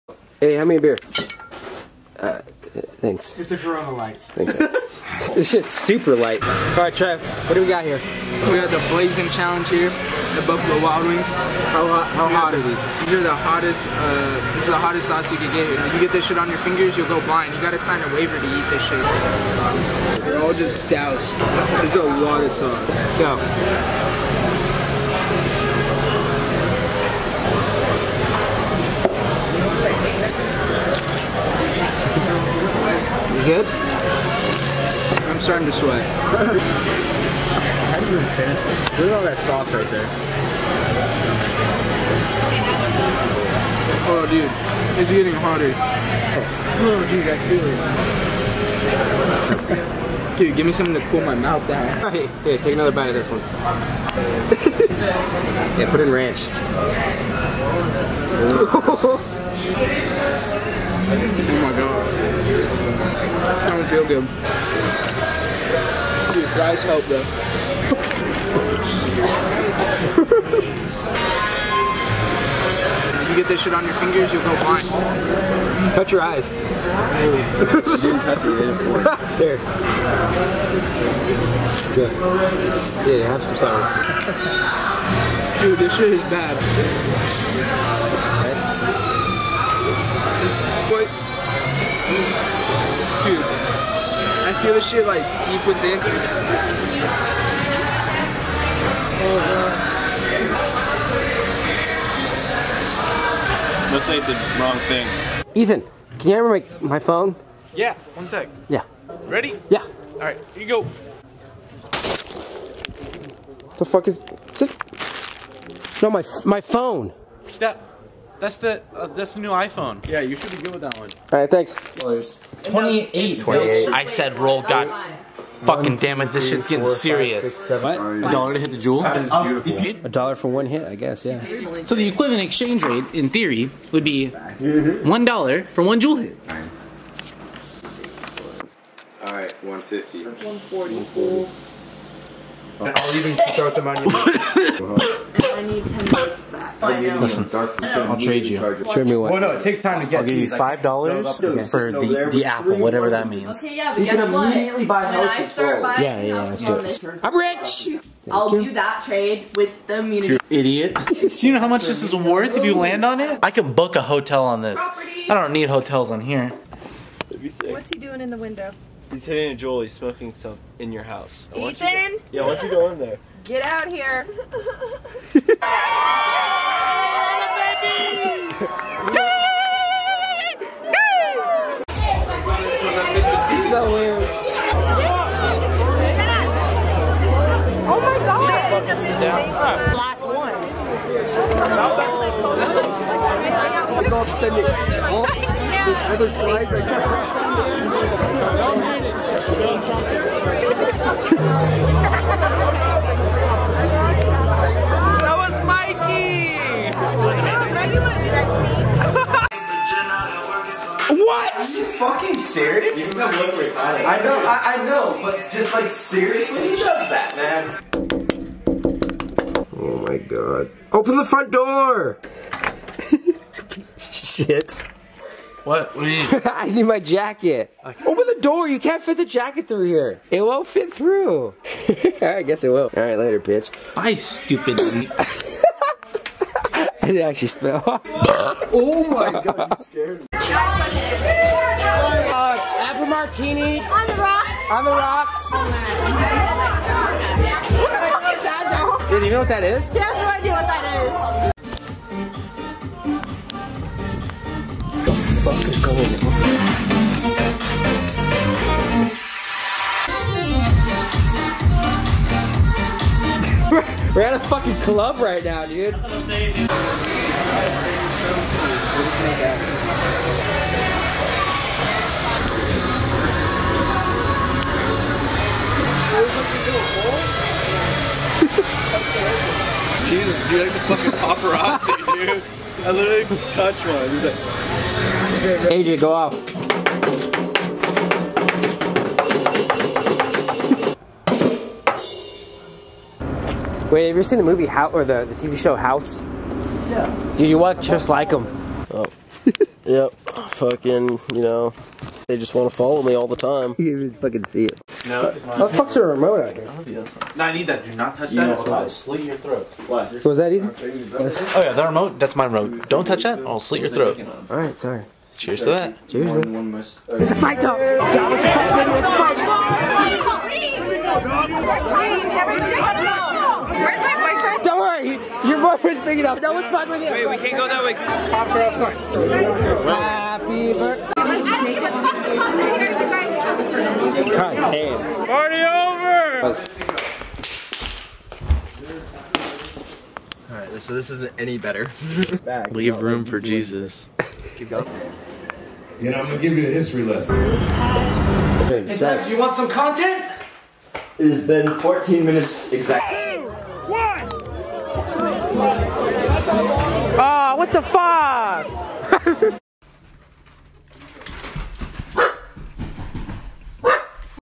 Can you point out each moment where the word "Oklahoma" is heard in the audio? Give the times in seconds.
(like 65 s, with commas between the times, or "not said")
not said.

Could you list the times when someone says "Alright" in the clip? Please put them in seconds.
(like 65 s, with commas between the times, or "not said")
52 s, 110 s.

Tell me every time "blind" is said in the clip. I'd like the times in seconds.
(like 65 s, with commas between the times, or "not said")
17 s, 74 s.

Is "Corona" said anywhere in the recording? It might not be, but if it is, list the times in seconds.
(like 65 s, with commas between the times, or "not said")
3 s.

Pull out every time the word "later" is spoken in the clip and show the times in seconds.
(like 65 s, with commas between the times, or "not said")
233 s.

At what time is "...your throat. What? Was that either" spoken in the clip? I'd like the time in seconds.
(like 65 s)
309 s.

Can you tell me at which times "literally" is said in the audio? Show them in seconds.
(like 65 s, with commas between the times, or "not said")
282 s.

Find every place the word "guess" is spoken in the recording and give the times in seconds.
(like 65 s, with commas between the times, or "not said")
130 s, 154 s, 232 s.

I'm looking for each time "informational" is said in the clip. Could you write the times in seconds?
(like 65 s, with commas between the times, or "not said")
not said.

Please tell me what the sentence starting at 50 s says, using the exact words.
dude, give me something to cool my mouth down.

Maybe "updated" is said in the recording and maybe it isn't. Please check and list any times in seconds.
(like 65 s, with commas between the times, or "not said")
not said.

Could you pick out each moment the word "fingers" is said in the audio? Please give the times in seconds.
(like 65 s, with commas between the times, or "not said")
16 s, 73 s.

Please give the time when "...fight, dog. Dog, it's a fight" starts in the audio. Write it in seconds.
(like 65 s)
317 s.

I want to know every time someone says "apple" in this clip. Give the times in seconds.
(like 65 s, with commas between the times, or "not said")
152 s, 242 s.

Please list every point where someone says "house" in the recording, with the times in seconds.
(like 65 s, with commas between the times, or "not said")
171 s, 295 s.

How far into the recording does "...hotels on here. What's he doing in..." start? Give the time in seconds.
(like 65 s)
165 s.